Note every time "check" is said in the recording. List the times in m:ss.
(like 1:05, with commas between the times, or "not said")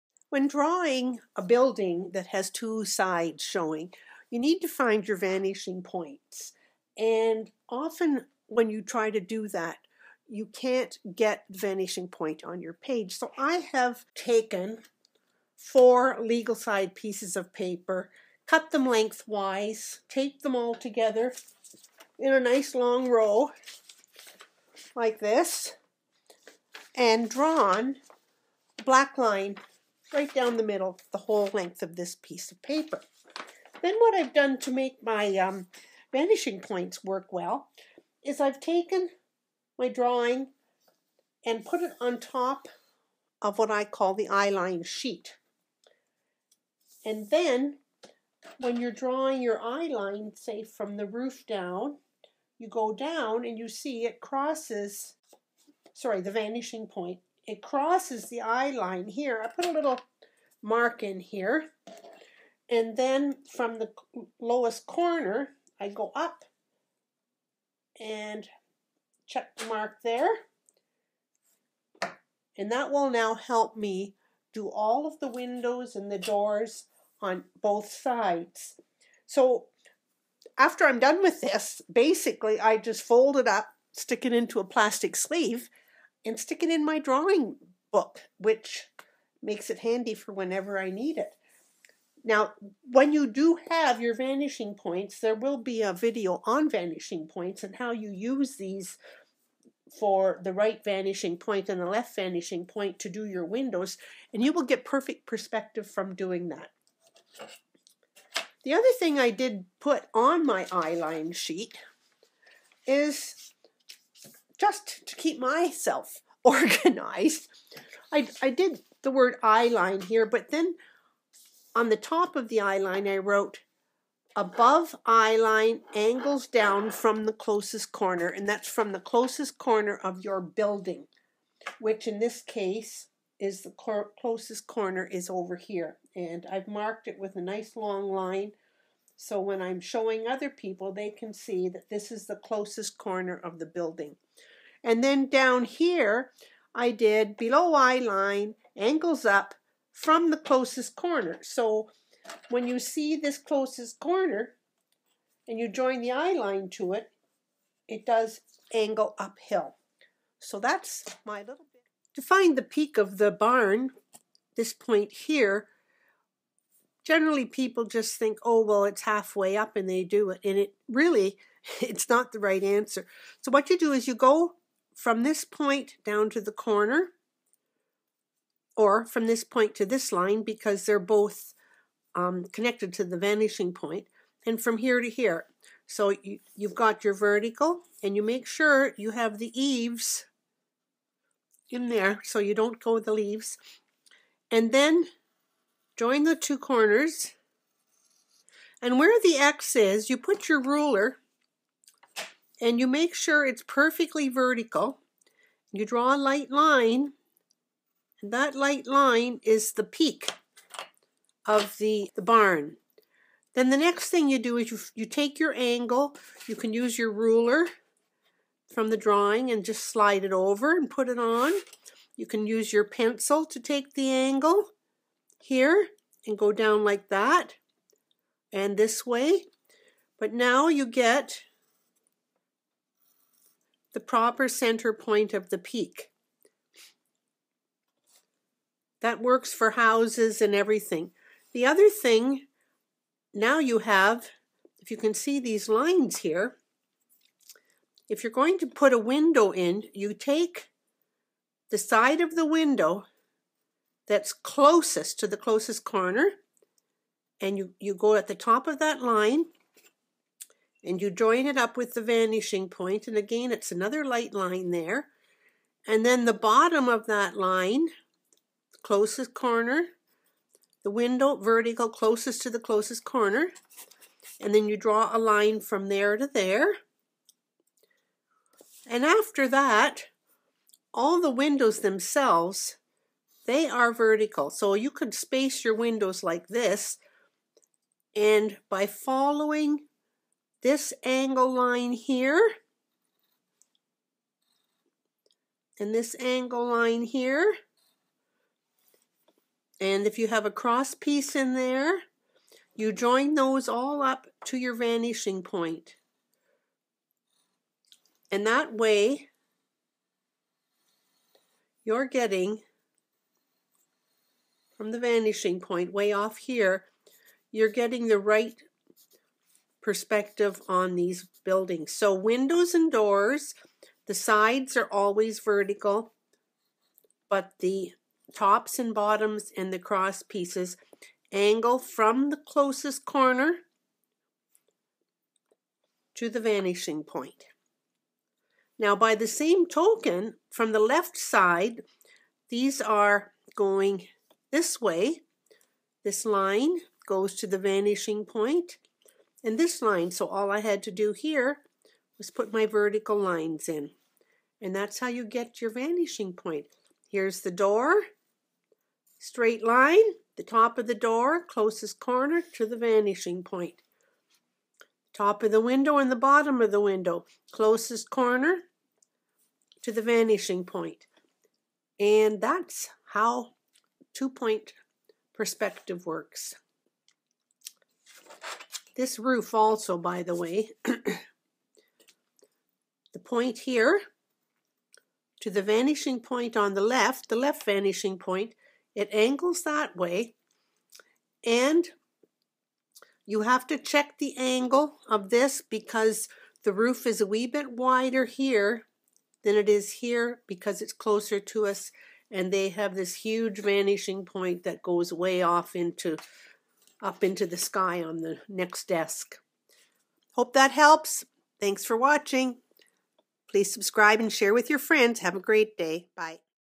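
1:09, 6:33.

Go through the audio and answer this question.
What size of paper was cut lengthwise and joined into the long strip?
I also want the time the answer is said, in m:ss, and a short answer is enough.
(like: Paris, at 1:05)
Legal, at 0:16.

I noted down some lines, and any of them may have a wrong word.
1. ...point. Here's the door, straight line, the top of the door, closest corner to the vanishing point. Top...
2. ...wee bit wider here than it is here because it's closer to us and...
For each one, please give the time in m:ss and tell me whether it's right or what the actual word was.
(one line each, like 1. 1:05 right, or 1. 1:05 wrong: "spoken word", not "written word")
1. 5:56 right
2. 6:37 right.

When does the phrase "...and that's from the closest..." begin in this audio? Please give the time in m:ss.
2:08.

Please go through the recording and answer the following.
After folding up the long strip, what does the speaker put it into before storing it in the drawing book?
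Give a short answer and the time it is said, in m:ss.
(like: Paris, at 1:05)
Plastic sleeve, at 1:24.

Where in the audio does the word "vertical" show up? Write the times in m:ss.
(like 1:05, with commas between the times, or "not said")
3:07, 3:24, 4:31, 4:43, 5:25, 5:52.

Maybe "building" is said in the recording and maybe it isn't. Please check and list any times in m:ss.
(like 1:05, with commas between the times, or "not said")
0:01, 2:10, 2:23, 5:21.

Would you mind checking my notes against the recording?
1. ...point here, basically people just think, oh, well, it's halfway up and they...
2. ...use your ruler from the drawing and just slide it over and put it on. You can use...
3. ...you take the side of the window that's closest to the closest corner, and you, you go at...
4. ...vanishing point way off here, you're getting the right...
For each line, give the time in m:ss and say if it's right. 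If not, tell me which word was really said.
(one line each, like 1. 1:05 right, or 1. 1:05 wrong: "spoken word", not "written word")
1. 2:44 wrong: "generally", not "basically"
2. 3:36 right
3. 4:09 right
4. 5:14 right.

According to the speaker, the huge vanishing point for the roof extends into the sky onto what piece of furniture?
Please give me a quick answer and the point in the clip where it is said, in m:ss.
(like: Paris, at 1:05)
Next desk, at 6:48.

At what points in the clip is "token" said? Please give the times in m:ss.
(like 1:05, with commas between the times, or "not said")
5:39.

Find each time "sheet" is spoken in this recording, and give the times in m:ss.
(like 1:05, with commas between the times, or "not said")
0:44, 1:51.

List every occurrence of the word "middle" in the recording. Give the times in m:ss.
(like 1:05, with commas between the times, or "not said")
0:30.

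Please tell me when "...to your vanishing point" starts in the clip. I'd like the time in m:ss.
5:04.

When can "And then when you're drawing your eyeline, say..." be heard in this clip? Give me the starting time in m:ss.
0:47.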